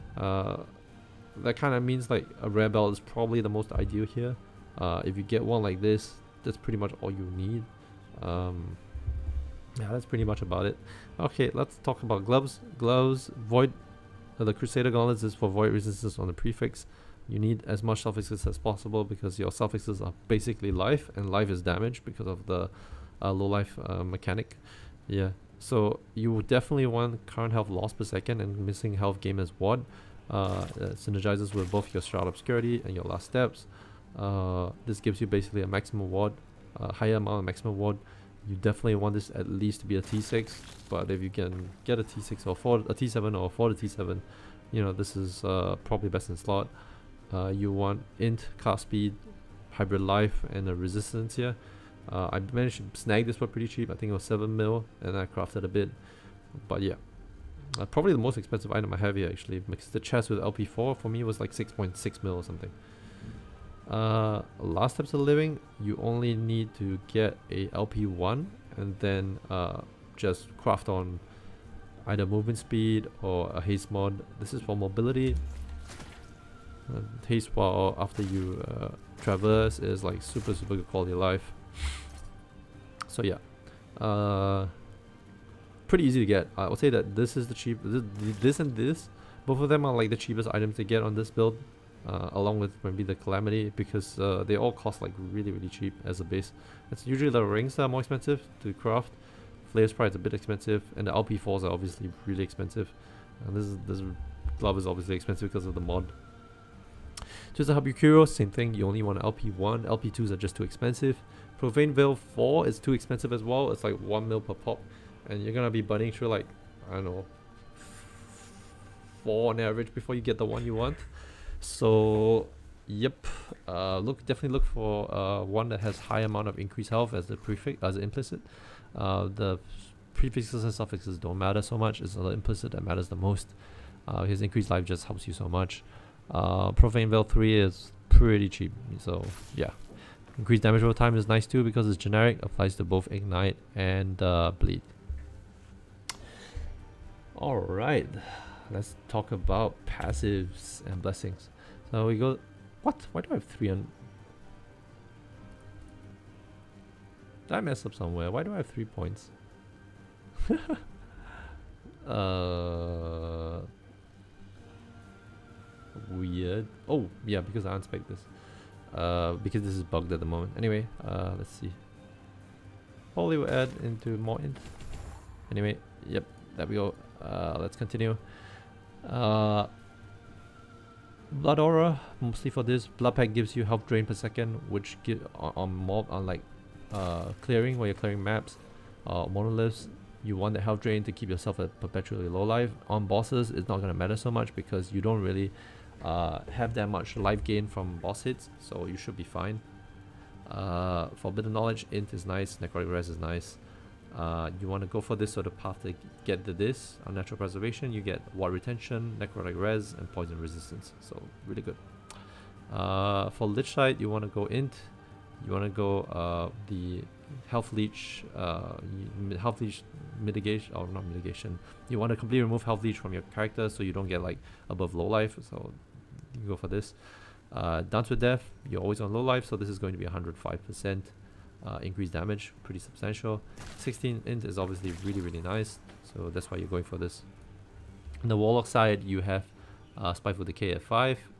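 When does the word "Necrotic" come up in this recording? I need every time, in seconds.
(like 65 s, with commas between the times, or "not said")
202 s, 209 s.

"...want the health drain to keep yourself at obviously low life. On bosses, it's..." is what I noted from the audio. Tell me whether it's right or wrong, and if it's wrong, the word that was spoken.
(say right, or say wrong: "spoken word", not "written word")
wrong: "perpetually", not "obviously".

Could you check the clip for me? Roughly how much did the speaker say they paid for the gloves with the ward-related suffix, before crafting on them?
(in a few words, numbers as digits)
7 million.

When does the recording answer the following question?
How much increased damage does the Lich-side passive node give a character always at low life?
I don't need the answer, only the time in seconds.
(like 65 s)
230 s.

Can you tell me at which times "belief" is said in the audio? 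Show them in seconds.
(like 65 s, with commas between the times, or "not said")
not said.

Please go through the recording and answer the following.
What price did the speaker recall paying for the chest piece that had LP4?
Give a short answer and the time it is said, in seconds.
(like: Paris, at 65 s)
6.6 million, at 61 s.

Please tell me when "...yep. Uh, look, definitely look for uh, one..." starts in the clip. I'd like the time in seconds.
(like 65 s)
122 s.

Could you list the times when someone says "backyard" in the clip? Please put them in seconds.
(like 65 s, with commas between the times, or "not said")
not said.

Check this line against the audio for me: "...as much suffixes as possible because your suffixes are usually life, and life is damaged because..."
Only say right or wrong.
wrong.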